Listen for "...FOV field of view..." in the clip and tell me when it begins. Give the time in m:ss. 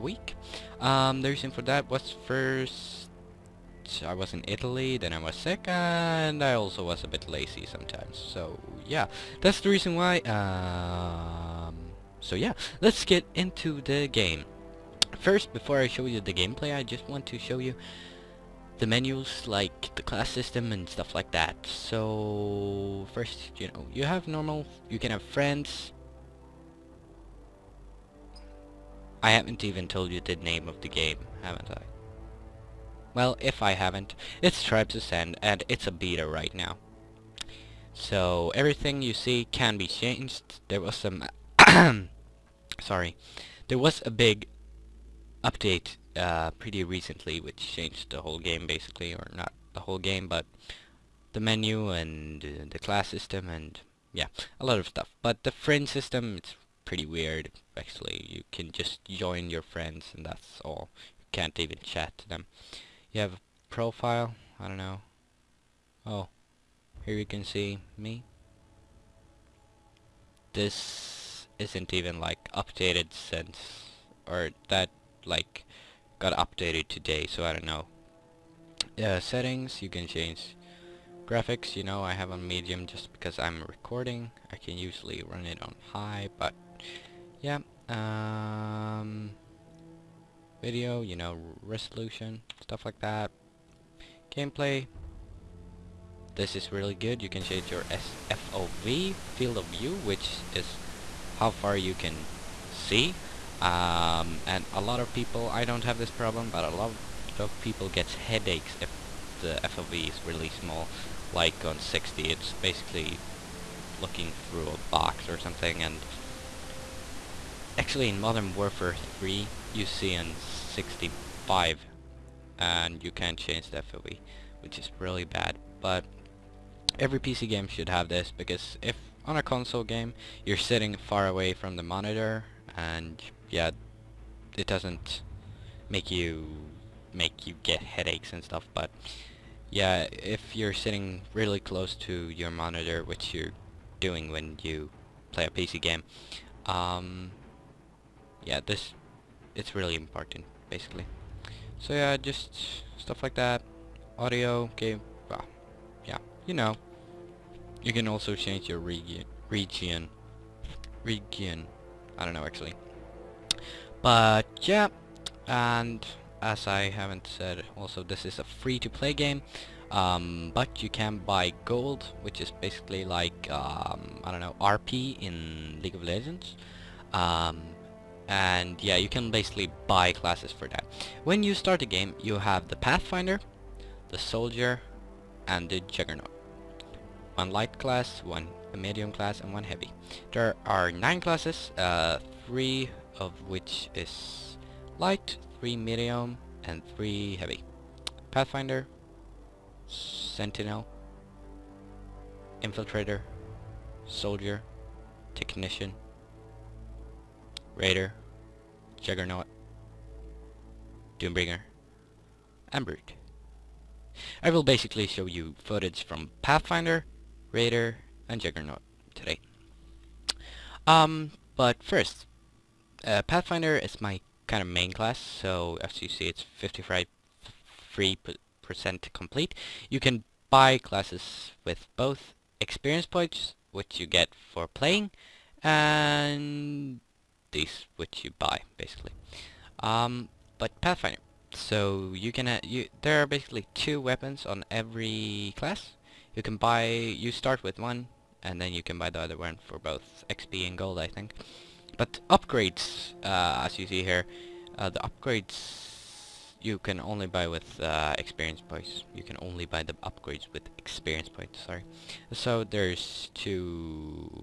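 1:38.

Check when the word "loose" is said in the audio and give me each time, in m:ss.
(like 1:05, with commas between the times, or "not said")
not said.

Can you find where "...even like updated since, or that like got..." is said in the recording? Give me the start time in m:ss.
1:11.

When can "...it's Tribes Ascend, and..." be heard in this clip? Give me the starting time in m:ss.
0:34.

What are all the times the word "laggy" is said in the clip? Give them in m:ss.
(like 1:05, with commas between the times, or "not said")
not said.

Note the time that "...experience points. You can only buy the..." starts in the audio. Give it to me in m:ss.
4:18.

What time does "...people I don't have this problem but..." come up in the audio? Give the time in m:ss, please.
1:45.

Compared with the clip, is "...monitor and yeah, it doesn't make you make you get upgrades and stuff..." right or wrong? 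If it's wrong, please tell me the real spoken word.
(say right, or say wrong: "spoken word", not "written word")
wrong: "headaches", not "upgrades".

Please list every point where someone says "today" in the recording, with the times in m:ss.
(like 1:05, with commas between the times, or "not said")
1:16, 3:39.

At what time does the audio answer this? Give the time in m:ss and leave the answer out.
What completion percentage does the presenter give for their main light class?
3:46.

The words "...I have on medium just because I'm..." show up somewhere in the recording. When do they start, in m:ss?
1:22.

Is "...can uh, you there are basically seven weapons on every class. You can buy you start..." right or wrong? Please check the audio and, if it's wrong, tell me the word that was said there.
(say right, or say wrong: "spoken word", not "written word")
wrong: "two", not "seven".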